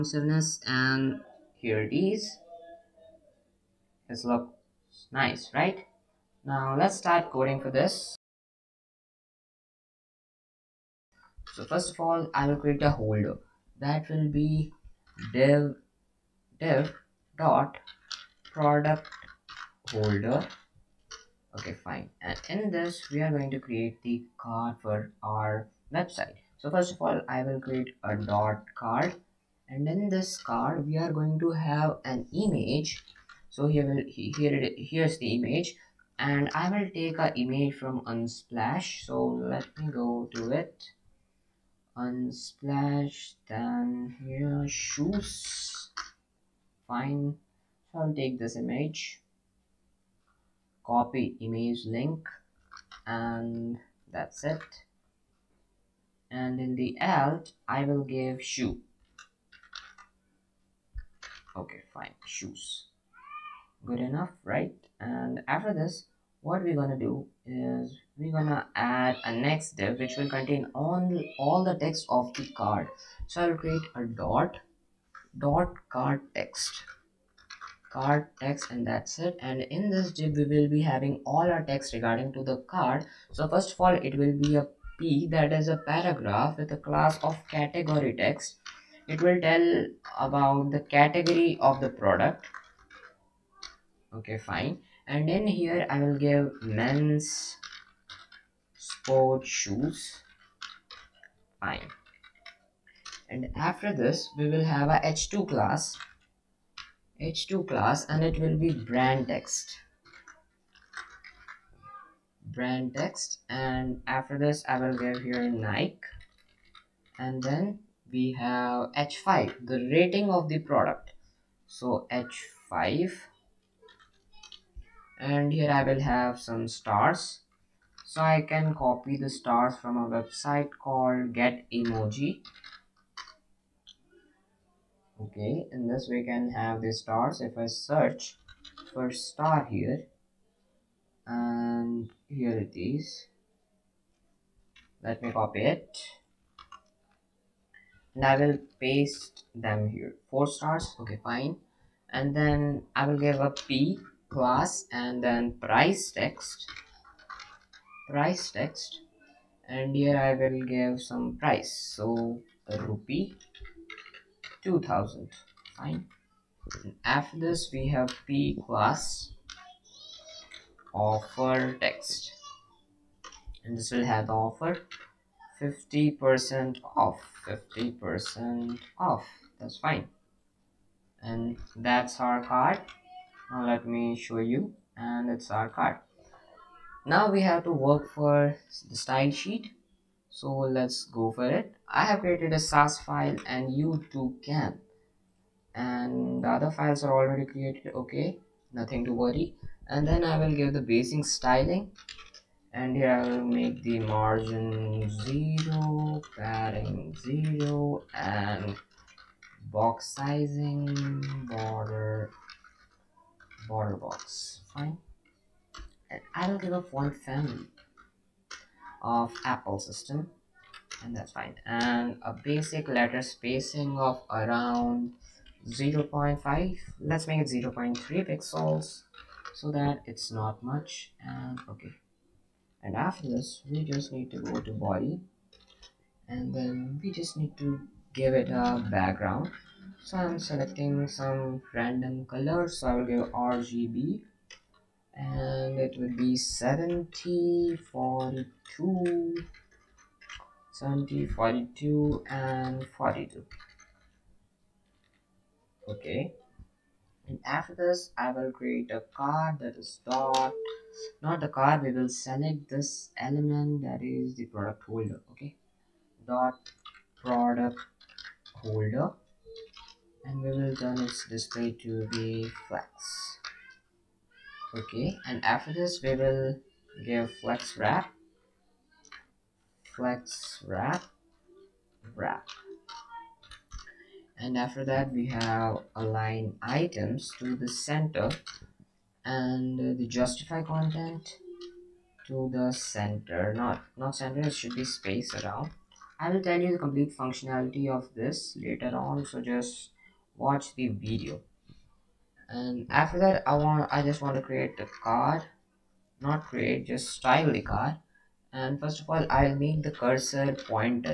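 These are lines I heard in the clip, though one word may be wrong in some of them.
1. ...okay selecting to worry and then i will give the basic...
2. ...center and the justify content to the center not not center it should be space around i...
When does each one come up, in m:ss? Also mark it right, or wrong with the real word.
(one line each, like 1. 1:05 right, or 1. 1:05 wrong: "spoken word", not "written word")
1. 3:17 wrong: "nothing", not "selecting"
2. 4:47 right.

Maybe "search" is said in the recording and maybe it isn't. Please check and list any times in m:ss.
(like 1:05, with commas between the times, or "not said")
2:17.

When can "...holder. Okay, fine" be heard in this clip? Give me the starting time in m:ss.
0:19.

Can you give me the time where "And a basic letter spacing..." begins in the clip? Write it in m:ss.
3:41.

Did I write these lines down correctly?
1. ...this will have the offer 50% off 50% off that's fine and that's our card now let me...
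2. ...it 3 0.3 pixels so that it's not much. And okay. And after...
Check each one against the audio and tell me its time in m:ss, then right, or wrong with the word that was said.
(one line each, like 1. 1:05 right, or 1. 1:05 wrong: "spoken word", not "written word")
1. 2:53 right
2. 3:47 wrong: "0", not "3".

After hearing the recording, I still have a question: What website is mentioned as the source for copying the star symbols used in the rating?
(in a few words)
Get Emoji.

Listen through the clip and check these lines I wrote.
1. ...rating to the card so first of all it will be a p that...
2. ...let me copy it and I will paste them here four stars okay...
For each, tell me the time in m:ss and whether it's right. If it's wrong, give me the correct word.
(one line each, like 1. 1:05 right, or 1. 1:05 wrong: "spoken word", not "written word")
1. 1:21 wrong: "regarding", not "rating"
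2. 2:25 right.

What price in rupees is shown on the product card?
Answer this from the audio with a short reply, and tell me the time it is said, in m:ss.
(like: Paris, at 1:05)
2000, at 2:42.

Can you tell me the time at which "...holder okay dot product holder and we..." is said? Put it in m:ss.
4:24.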